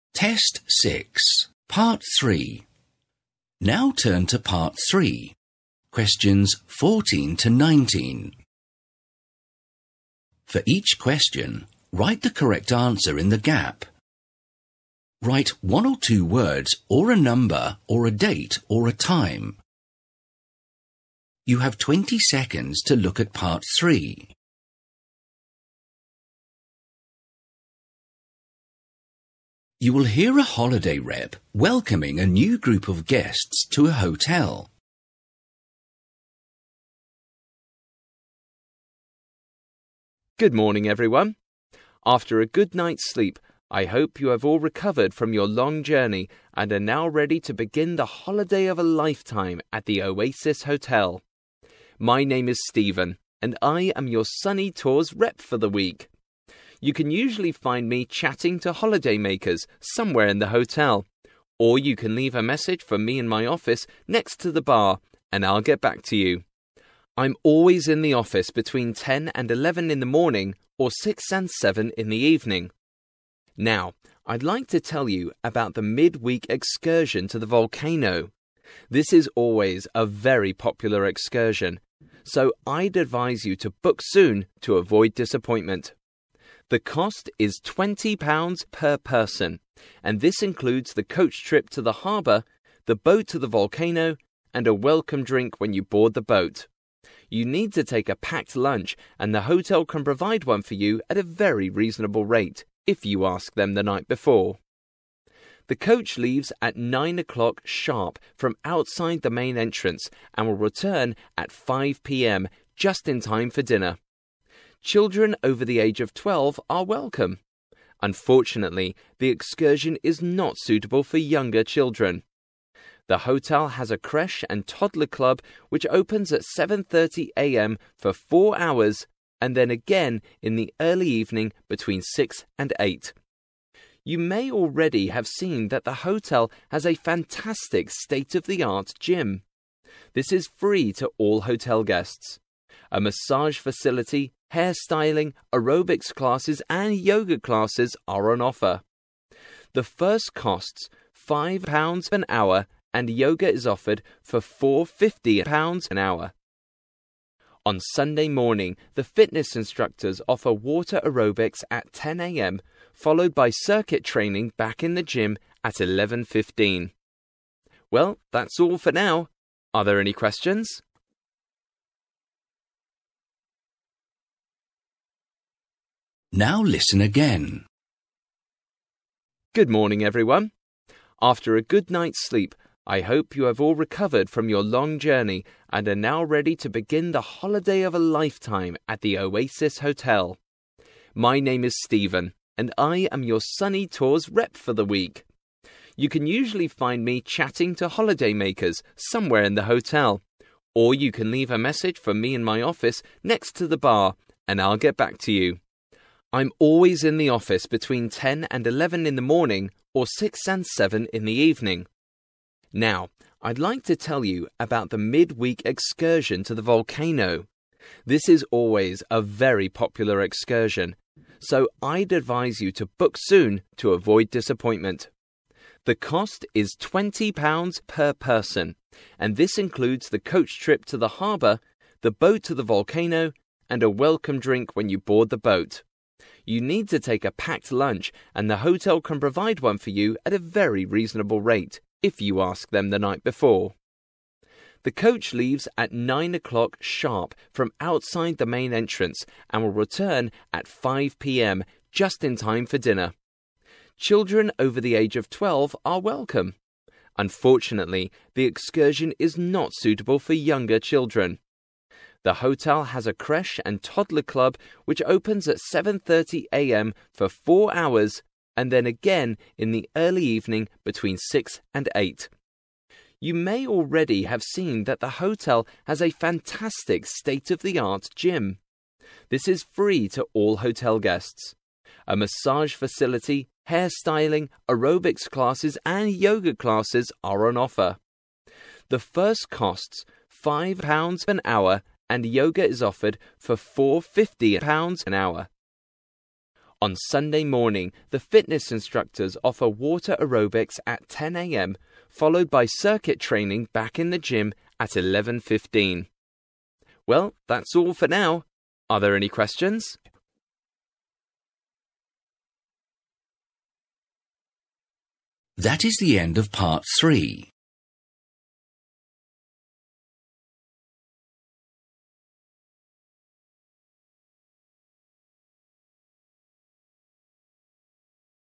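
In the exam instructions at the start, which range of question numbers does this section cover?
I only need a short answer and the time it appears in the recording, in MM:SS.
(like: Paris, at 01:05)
14 to 19, at 00:06.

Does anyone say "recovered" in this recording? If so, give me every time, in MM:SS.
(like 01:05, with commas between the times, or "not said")
00:44, 03:03.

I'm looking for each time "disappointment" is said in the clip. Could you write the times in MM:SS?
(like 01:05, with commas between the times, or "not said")
01:25, 03:44.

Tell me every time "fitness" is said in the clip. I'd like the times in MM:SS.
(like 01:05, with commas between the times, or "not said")
02:39, 04:58.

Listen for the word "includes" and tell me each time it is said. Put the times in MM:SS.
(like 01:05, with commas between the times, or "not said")
01:30, 03:49.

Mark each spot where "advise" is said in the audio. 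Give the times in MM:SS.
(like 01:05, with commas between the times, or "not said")
01:22, 03:42.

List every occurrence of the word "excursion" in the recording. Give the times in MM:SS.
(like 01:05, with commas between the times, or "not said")
01:16, 01:21, 01:59, 03:35, 03:40, 04:18.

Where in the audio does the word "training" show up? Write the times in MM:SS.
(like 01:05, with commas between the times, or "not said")
02:44, 05:03.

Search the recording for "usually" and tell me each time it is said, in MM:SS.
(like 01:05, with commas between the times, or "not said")
00:57, 03:16.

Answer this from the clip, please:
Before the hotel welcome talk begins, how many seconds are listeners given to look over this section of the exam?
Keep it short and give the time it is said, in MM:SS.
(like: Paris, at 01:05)
20, at 00:21.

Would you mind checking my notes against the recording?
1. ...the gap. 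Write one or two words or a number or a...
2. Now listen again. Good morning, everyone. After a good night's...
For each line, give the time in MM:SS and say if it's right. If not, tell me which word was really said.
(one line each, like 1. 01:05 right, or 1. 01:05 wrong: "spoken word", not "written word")
1. 00:13 right
2. 02:56 right.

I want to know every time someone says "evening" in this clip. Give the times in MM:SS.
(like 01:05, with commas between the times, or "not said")
01:12, 02:11, 03:31, 04:30.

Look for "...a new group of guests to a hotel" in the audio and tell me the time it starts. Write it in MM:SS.
00:32.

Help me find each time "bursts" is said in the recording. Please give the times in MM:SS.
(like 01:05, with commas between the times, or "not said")
not said.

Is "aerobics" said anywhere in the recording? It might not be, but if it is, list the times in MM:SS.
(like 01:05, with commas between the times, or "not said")
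02:25, 02:41, 04:44, 05:00.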